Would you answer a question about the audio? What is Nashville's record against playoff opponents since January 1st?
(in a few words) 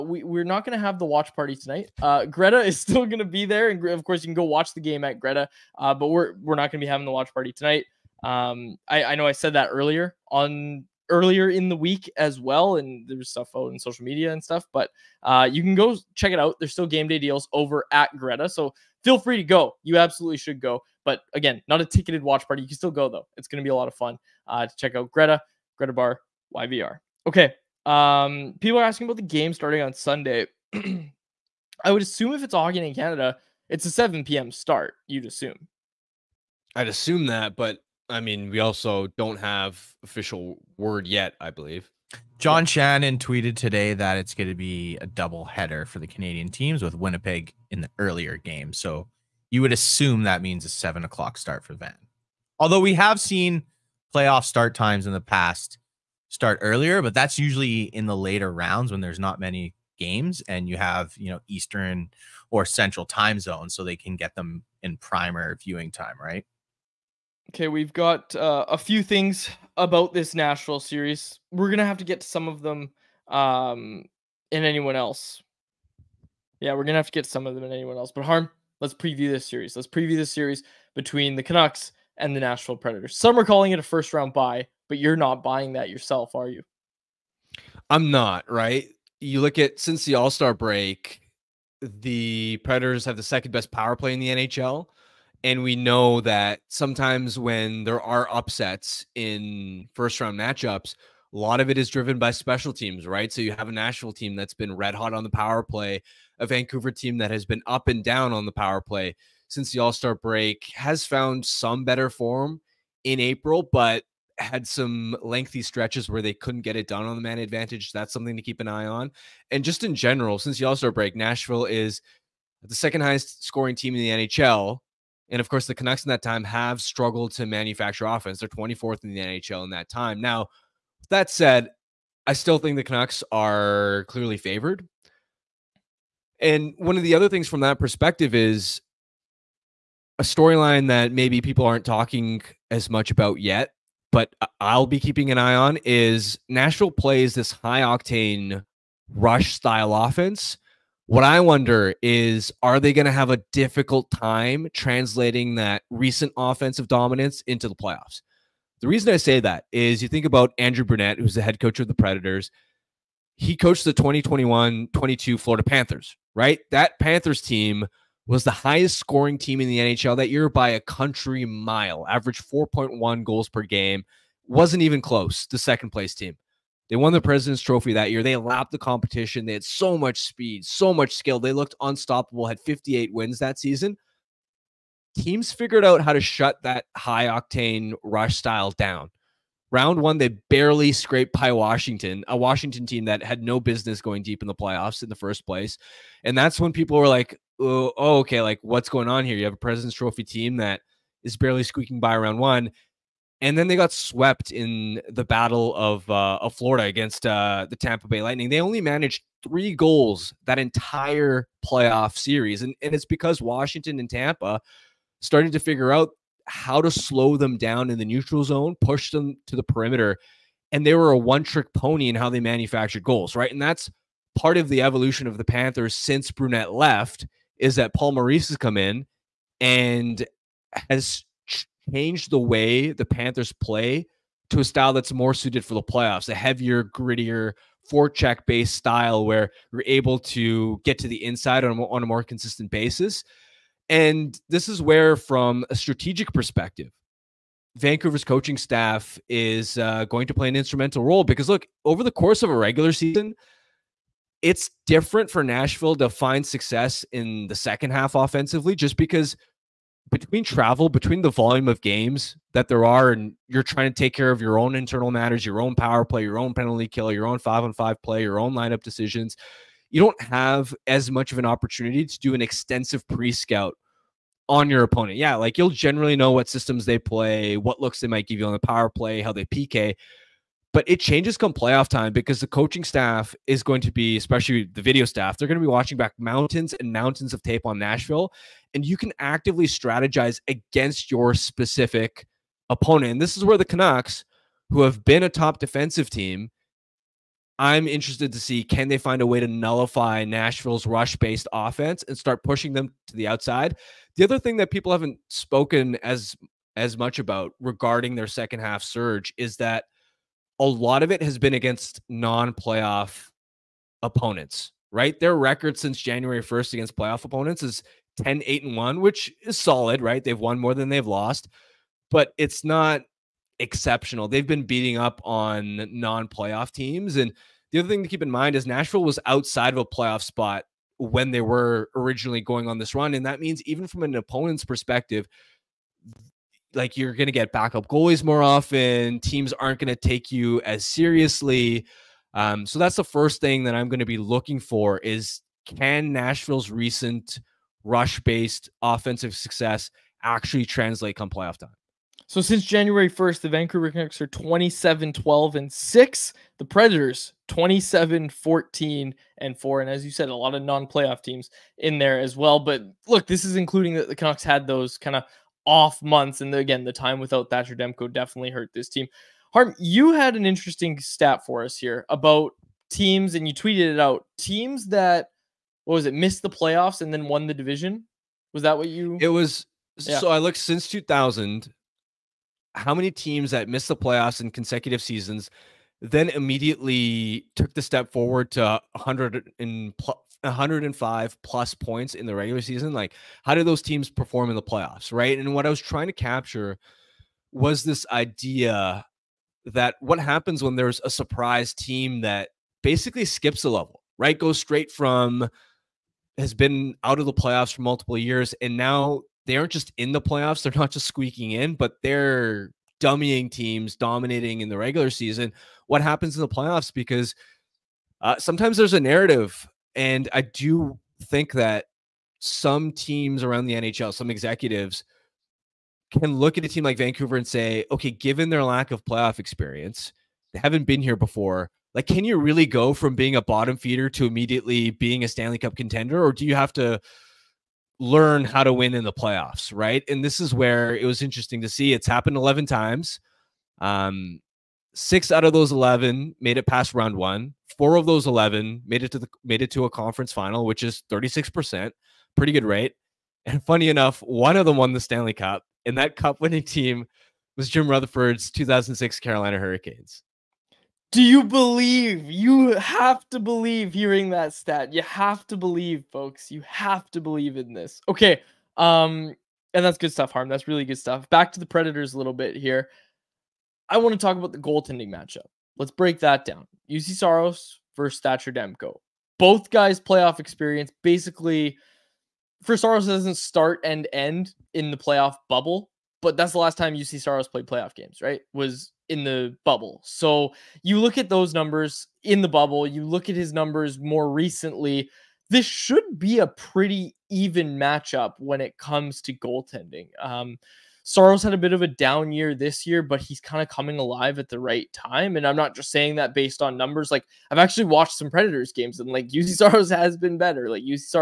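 10-8-1.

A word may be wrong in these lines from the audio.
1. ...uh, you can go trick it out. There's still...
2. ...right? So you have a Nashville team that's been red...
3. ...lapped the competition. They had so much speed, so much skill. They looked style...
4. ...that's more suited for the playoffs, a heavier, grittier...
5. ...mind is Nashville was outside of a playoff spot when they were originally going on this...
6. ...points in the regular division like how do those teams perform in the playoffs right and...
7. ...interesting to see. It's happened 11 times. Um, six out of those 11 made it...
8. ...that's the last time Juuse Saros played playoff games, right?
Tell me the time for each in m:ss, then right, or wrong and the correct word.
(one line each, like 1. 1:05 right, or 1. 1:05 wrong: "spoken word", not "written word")
1. 0:15 wrong: "check", not "trick"
2. 1:43 right
3. 2:58 wrong: "unstoppable", not "style"
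4. 3:54 right
5. 5:28 right
6. 6:31 wrong: "season", not "division"
7. 7:21 right
8. 8:06 right.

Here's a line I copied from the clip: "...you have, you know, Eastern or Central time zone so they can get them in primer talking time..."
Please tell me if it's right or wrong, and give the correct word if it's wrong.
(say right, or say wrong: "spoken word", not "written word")
wrong: "viewing", not "talking".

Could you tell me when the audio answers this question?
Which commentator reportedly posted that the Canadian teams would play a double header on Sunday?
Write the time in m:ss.
0:42.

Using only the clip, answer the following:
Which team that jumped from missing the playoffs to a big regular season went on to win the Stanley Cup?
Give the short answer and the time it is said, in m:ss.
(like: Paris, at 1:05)
2006 Carolina Hurricanes, at 7:38.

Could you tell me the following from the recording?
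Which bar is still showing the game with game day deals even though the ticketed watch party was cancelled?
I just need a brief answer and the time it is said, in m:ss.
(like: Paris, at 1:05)
Greta Bar, at 0:25.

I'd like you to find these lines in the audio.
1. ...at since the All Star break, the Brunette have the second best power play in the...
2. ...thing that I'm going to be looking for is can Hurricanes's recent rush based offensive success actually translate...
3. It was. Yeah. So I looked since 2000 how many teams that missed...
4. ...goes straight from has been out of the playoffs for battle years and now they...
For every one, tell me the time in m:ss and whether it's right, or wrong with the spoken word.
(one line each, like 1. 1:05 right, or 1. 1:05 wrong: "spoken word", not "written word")
1. 1:29 wrong: "Predators", not "Brunette"
2. 5:43 wrong: "Nashville", not "Hurricanes"
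3. 6:19 right
4. 6:44 wrong: "multiple", not "battle".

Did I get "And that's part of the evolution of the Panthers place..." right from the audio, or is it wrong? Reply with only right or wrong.
wrong.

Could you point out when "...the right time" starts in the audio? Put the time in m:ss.
8:24.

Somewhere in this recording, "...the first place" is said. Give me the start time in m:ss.
3:15.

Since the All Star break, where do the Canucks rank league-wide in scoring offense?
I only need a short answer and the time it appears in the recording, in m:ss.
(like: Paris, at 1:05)
24th, at 2:08.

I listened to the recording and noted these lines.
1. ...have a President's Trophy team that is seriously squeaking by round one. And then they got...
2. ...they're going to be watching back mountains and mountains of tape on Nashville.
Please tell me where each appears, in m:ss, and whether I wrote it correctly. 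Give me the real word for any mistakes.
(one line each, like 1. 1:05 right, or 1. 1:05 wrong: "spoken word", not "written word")
1. 3:19 wrong: "barely", not "seriously"
2. 4:45 right.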